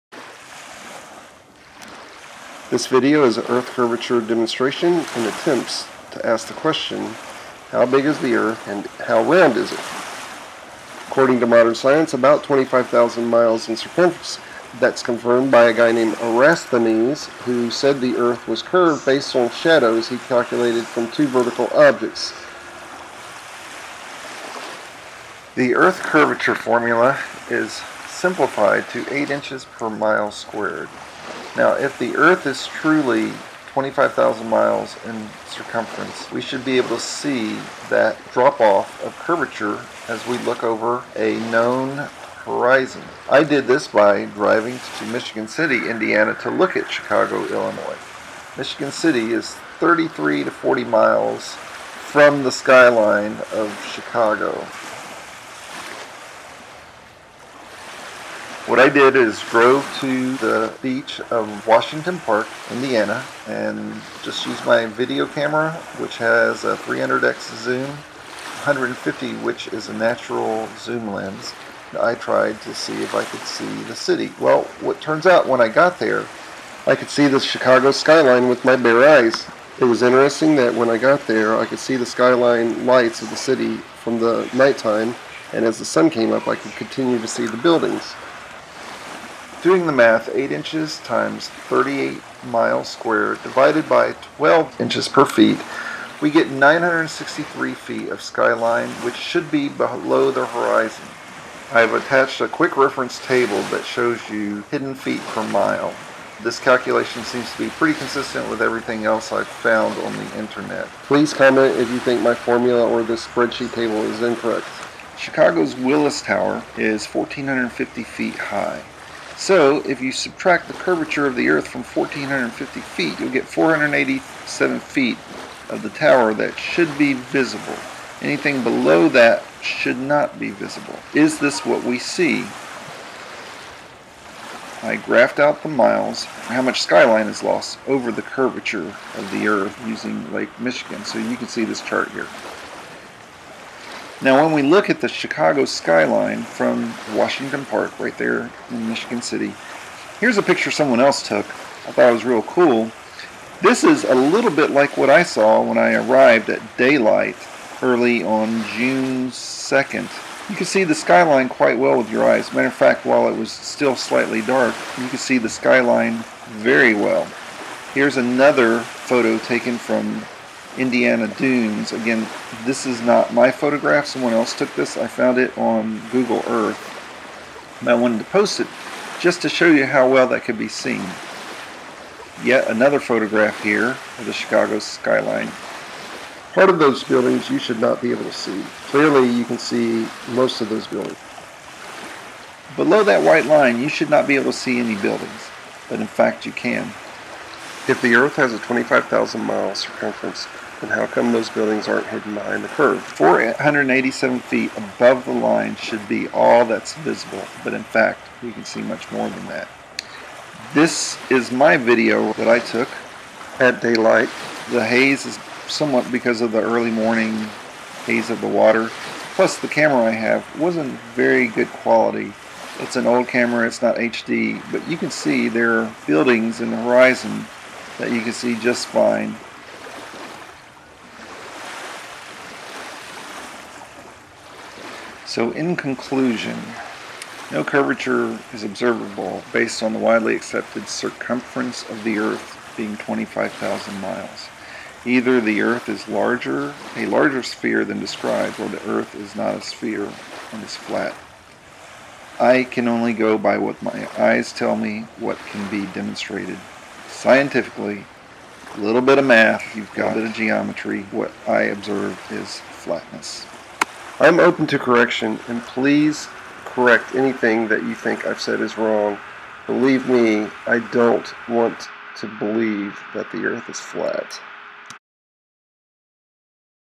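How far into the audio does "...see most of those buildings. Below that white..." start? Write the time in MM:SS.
03:09.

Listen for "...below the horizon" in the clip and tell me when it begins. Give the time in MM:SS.
01:39.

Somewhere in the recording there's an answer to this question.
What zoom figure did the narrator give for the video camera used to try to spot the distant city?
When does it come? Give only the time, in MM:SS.
01:06.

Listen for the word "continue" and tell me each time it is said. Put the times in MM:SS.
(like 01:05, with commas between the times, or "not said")
01:26.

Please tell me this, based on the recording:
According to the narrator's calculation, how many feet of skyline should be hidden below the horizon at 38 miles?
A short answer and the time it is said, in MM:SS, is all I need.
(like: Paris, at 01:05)
963 feet, at 01:36.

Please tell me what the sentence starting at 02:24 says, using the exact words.
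Now, when we look at the Chicago skyline from Washington Park, right there in Michigan City, here's a picture someone else took.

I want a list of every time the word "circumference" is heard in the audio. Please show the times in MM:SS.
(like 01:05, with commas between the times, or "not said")
00:13, 00:35, 03:19, 04:00.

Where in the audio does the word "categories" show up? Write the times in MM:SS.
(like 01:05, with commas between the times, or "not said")
not said.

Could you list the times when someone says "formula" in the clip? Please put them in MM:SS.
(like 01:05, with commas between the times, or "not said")
00:26, 01:52.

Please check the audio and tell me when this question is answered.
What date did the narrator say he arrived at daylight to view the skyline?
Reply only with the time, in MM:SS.
02:38.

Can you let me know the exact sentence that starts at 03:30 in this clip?
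This is my video that I took at daylight.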